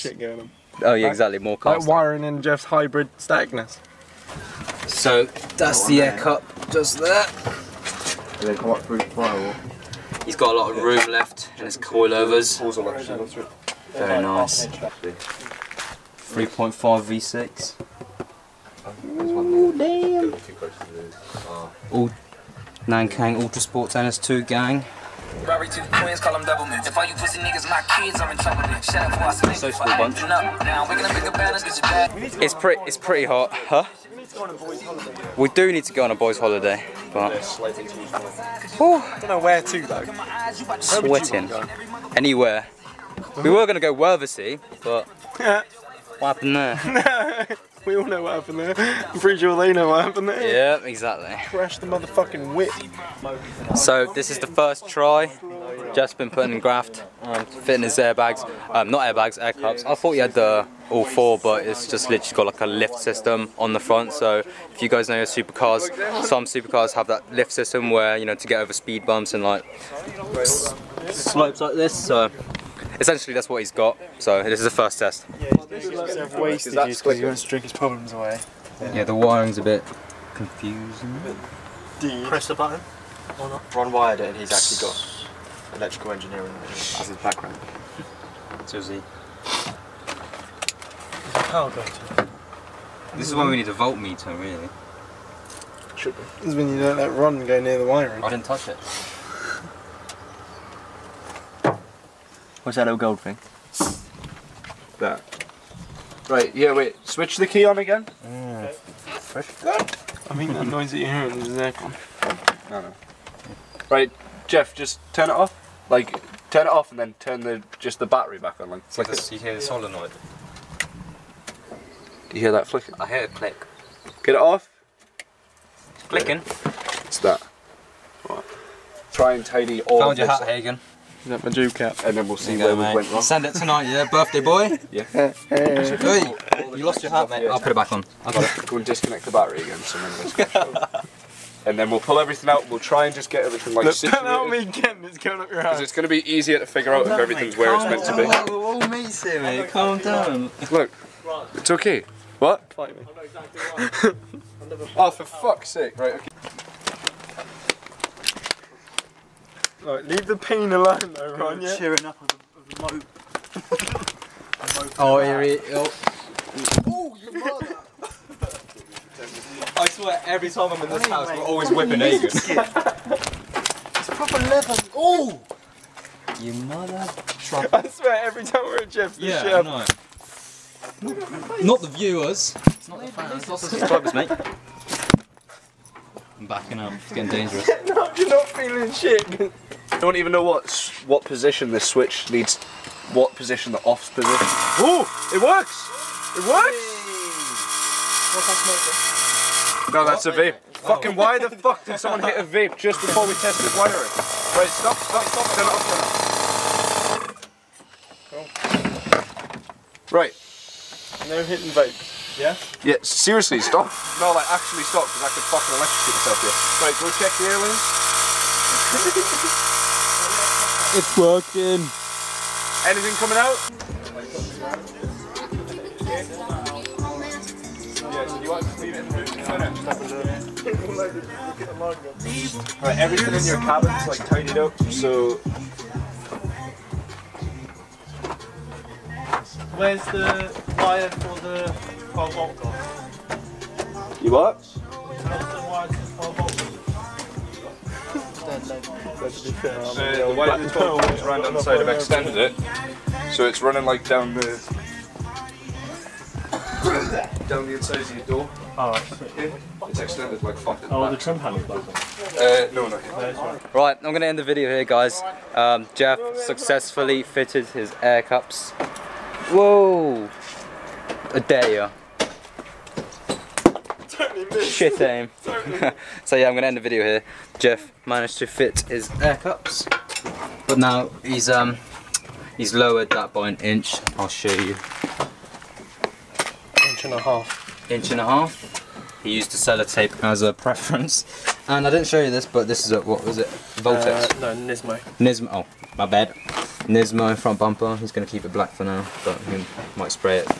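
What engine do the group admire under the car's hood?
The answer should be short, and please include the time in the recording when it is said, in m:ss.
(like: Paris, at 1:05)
3.5 V6, at 0:14.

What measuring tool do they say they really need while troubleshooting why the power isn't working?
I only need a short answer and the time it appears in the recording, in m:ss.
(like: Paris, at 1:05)
Voltmeter, at 1:33.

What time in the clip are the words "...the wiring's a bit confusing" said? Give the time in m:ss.
1:19.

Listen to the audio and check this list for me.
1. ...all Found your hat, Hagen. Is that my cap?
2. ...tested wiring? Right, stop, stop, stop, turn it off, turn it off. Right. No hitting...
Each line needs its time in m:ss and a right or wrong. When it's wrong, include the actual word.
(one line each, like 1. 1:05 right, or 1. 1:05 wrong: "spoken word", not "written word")
1. 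2:09 right
2. 3:23 right.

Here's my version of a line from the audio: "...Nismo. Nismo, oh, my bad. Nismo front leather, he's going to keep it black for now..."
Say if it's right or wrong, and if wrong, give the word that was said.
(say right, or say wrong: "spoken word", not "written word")
wrong: "bumper", not "leather".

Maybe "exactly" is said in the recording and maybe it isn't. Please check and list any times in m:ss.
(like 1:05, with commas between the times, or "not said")
0:01, 0:50, 1:51.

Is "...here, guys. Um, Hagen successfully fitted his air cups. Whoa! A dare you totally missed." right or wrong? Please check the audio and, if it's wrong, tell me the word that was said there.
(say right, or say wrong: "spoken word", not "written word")
wrong: "Jeff", not "Hagen".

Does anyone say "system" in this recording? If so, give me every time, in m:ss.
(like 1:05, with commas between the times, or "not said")
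1:02, 1:07.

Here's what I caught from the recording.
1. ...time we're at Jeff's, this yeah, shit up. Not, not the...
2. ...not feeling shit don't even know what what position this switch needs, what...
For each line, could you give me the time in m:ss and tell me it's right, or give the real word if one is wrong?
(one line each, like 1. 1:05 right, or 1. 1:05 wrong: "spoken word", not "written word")
1. 2:58 right
2. 3:08 right.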